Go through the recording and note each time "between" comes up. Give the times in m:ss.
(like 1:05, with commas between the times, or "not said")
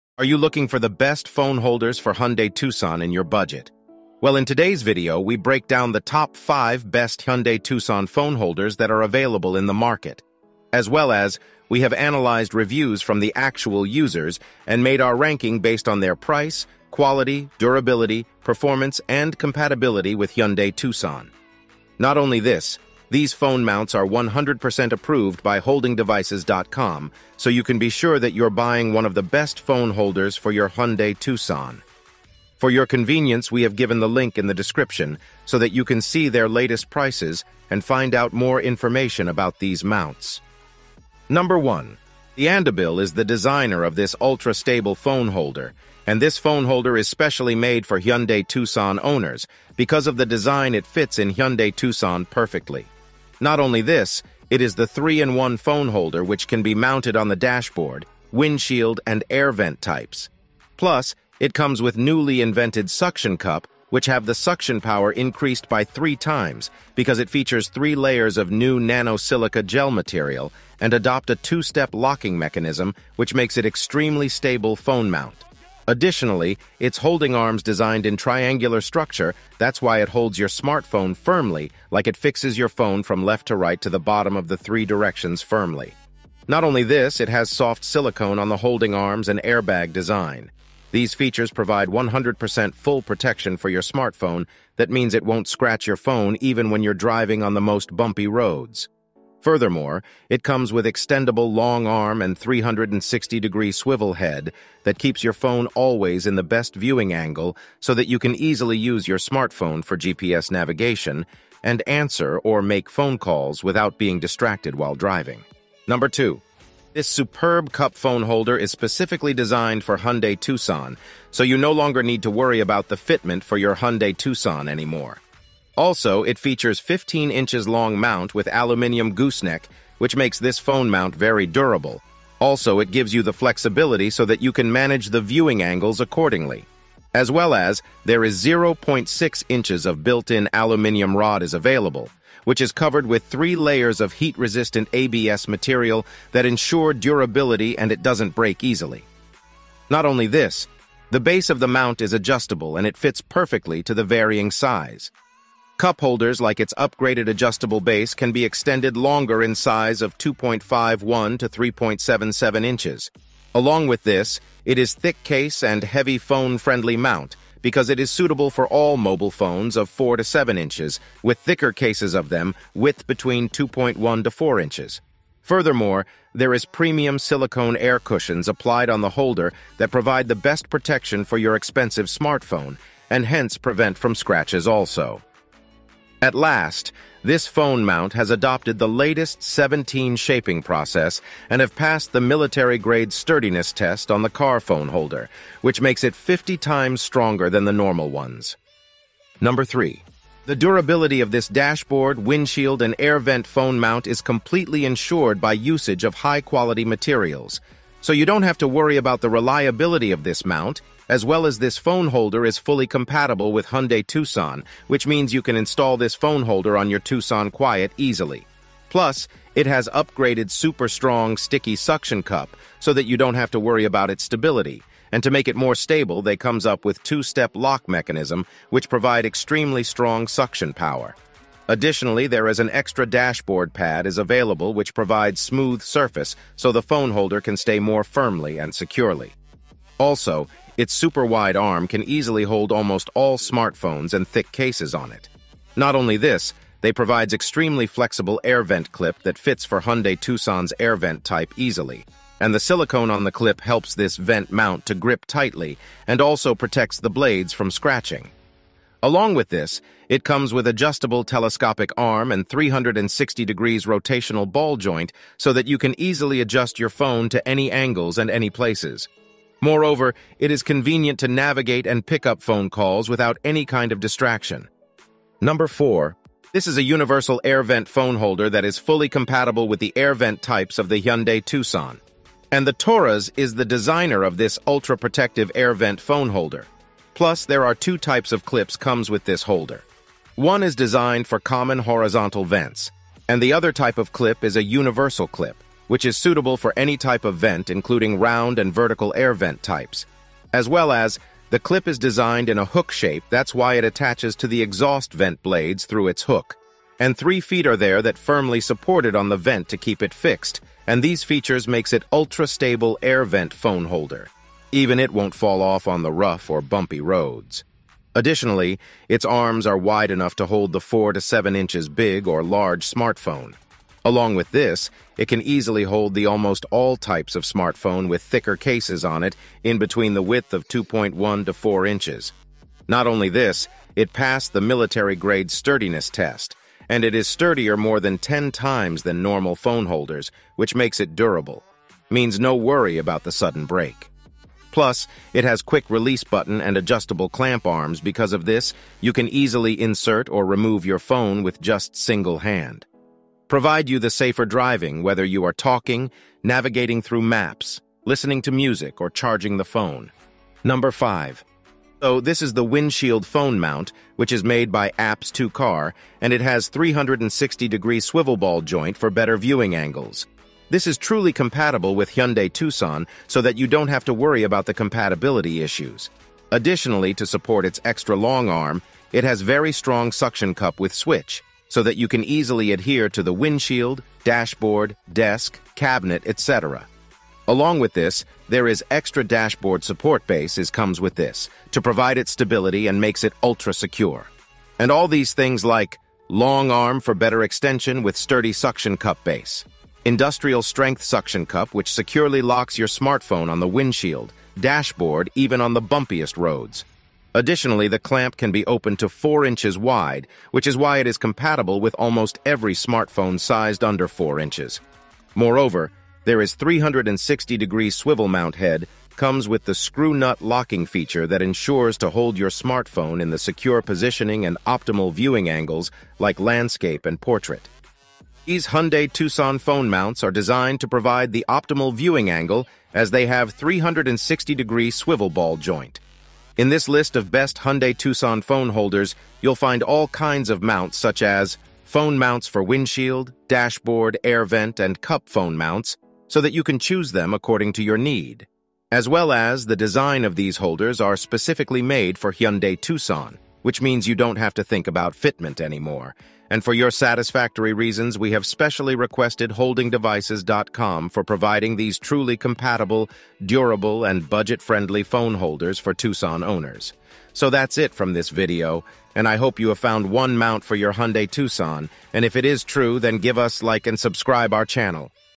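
2:53, 5:29.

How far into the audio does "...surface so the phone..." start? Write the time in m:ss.
3:55.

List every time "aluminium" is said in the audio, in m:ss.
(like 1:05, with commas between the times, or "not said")
2:08, 2:20.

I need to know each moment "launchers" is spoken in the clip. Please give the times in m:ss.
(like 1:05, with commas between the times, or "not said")
not said.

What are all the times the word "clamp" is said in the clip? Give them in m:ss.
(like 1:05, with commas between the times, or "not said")
5:47, 6:47.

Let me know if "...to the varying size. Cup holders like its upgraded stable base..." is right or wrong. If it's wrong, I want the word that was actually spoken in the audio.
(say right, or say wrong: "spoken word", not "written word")
wrong: "adjustable", not "stable".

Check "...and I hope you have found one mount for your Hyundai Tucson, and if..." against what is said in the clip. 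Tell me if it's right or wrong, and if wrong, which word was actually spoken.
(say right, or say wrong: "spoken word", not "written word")
right.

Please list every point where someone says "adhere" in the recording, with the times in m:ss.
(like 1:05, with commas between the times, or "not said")
6:22.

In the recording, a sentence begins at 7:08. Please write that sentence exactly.
These Hyundai Tucson phone mounts are designed to provide the optimal viewing angle as they have 360-degree swivel ball joint.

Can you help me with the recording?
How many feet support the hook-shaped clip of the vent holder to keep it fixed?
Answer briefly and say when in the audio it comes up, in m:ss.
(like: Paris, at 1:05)
3, at 5:07.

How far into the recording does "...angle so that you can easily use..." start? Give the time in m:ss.
1:47.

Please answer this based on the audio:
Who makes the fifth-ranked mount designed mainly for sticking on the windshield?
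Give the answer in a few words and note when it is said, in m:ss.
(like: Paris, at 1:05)
APPS2Car, at 6:04.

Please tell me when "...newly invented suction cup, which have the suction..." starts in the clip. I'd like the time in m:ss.
1:01.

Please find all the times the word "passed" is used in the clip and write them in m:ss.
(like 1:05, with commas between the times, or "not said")
3:11, 5:34.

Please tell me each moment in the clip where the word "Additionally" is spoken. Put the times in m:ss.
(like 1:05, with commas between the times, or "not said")
1:15, 3:51, 5:18, 6:16, 6:47.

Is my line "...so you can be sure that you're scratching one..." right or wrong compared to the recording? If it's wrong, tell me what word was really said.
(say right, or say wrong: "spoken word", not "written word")
wrong: "buying", not "scratching".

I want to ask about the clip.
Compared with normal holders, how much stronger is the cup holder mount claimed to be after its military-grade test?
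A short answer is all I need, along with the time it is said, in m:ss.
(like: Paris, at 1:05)
50 times, at 3:16.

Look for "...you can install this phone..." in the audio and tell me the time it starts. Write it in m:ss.
3:35.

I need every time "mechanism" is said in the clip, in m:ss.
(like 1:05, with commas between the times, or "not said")
1:12, 3:47.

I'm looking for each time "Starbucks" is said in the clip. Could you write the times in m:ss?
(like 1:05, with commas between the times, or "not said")
not said.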